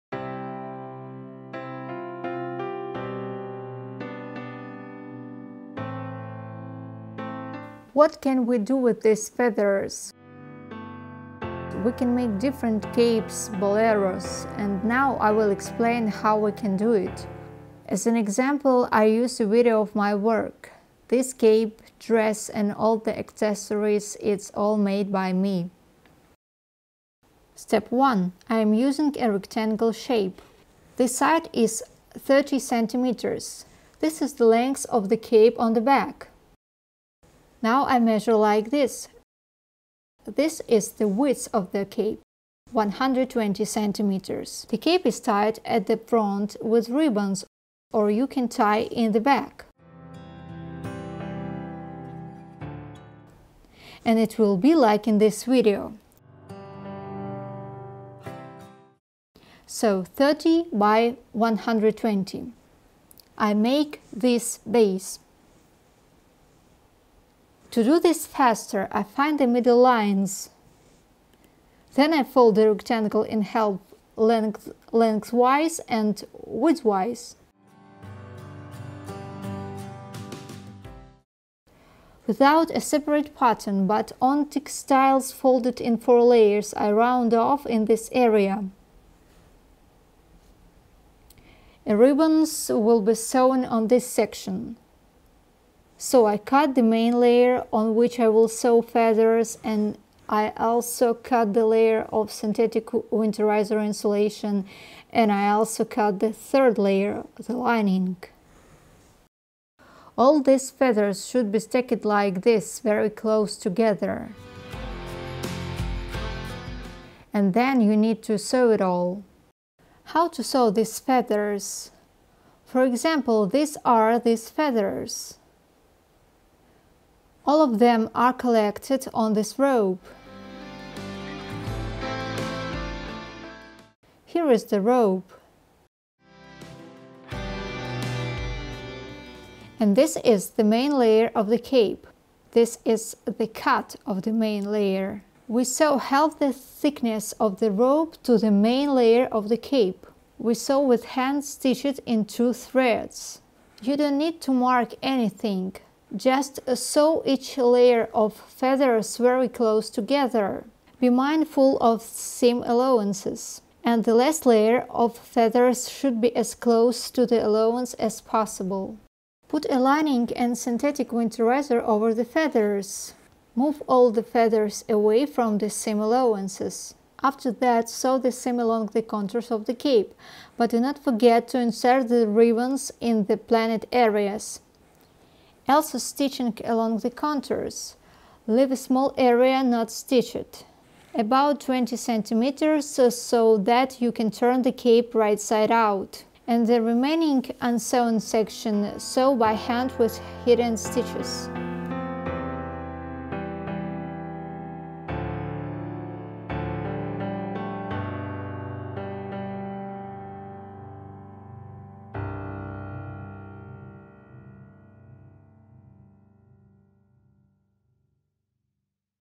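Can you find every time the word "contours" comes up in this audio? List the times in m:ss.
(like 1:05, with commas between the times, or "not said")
2:59, 3:07.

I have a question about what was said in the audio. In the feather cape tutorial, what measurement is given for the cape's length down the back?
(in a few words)
30 centimeters.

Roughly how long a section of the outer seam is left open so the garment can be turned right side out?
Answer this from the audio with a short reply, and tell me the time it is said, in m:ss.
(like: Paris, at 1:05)
20 centimeters, at 3:11.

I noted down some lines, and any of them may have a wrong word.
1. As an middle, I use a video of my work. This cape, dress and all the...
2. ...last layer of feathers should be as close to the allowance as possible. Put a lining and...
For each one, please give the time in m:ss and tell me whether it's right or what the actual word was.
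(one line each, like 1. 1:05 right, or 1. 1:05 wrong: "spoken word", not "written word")
1. 0:17 wrong: "example", not "middle"
2. 2:44 right.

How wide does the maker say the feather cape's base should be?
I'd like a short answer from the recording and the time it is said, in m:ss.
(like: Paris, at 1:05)
120 centimeters, at 0:42.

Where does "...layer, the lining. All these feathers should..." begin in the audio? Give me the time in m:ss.
1:46.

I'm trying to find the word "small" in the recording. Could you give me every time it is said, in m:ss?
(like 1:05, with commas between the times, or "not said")
3:08.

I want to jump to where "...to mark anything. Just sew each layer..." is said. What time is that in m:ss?
2:34.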